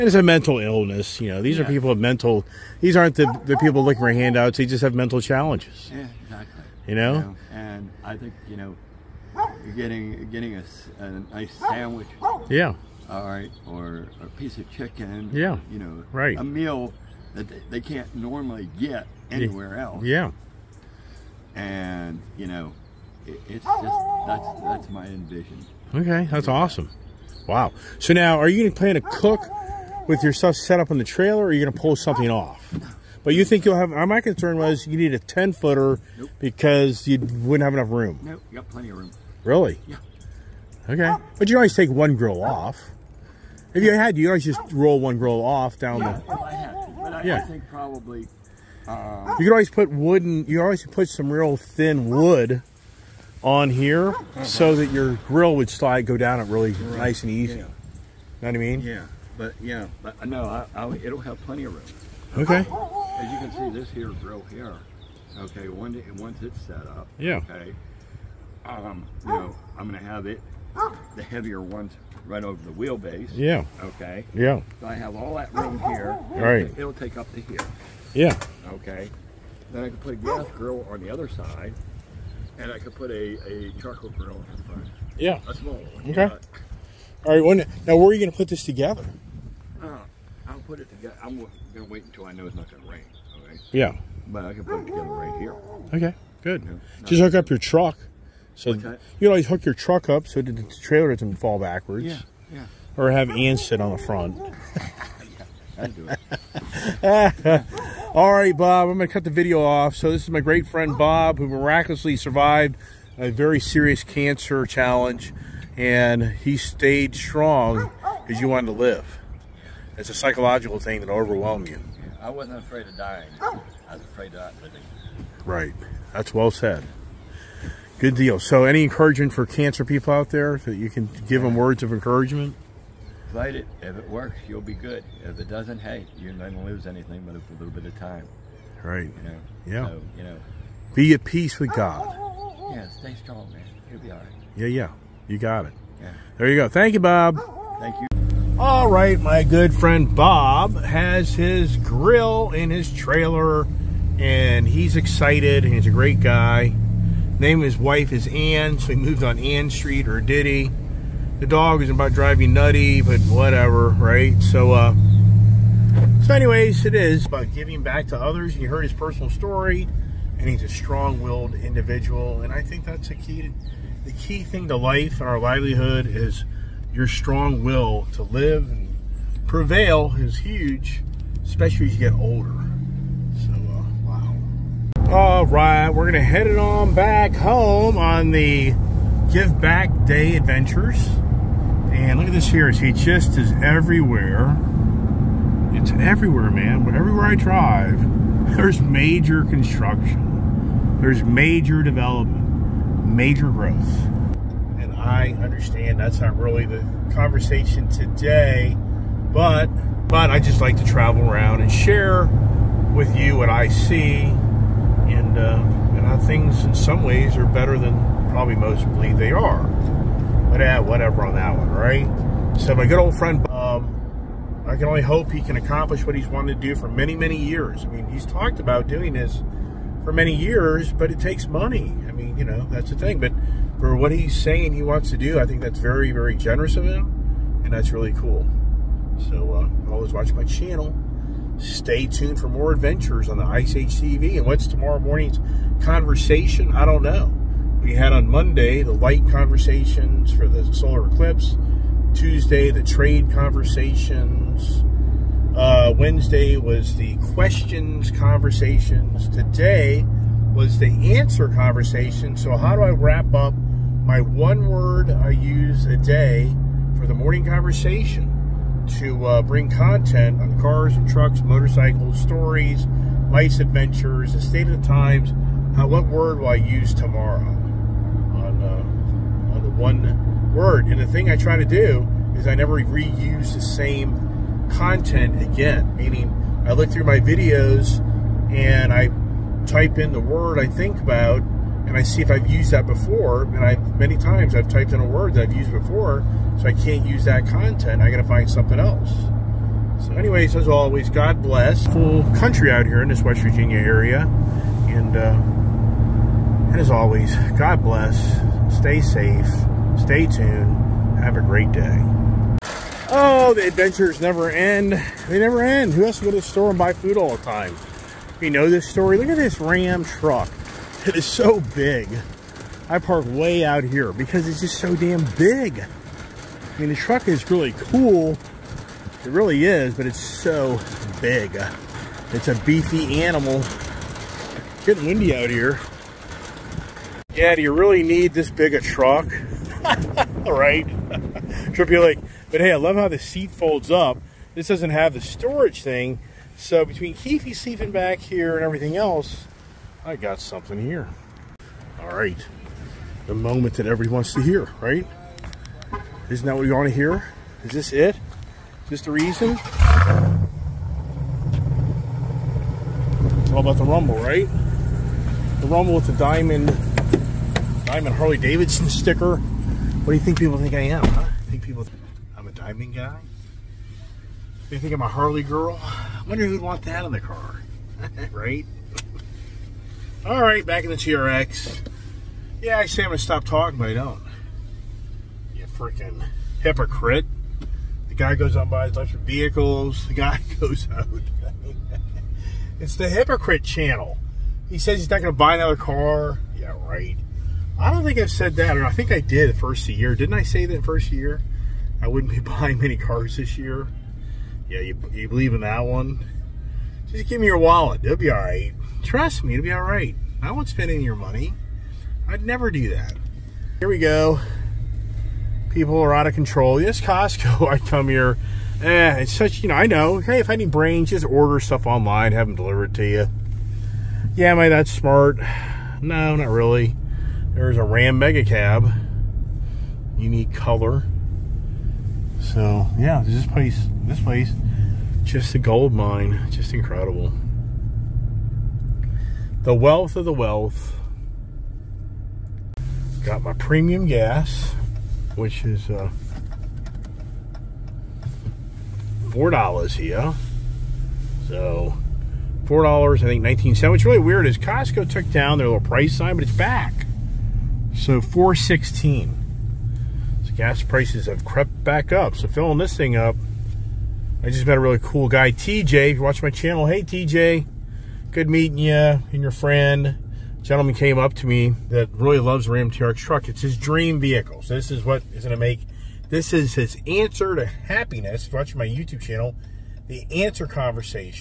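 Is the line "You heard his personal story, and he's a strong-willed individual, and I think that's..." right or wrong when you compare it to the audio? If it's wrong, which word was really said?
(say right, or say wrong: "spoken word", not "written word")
right.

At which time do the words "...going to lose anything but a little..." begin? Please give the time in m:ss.
2:16.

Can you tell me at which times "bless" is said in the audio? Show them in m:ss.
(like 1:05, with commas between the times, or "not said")
5:01, 5:07.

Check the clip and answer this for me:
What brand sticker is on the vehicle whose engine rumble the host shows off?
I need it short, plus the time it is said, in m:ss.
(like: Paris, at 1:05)
Diamond Harley Davidson, at 6:07.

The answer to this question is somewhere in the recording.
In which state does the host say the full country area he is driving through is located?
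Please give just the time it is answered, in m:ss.
5:03.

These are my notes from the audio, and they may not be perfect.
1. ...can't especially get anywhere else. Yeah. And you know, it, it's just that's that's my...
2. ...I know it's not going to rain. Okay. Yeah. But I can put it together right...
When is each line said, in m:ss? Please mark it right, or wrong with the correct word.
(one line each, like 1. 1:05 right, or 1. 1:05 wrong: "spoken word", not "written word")
1. 0:17 wrong: "normally", not "especially"
2. 1:32 right.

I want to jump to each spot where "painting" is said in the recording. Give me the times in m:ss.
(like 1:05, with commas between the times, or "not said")
not said.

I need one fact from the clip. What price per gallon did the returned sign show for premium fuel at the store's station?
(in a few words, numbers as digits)
$4.16.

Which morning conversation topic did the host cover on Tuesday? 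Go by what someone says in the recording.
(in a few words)
trade.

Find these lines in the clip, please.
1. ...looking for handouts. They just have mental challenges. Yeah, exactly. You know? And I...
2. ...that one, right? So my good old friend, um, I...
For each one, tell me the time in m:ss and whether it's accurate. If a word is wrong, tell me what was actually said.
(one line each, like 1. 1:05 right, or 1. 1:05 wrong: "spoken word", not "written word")
1. 0:03 right
2. 3:41 right.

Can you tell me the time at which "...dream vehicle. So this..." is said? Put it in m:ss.
7:53.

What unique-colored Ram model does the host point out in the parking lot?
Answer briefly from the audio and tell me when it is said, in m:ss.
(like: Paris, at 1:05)
Ram Mega Cab, at 7:07.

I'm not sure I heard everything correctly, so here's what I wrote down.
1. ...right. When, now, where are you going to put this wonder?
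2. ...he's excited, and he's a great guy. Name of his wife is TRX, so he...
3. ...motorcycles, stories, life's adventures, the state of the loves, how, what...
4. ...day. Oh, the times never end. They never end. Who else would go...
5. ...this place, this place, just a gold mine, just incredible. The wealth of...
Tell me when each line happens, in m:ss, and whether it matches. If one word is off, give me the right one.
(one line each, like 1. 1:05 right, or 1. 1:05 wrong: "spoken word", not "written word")
1. 1:27 wrong: "together", not "wonder"
2. 2:34 wrong: "Ann", not "TRX"
3. 4:31 wrong: "times", not "loves"
4. 5:11 wrong: "adventures", not "times"
5. 7:13 right.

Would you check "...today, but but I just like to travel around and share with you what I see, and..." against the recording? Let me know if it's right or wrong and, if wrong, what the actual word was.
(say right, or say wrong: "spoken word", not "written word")
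right.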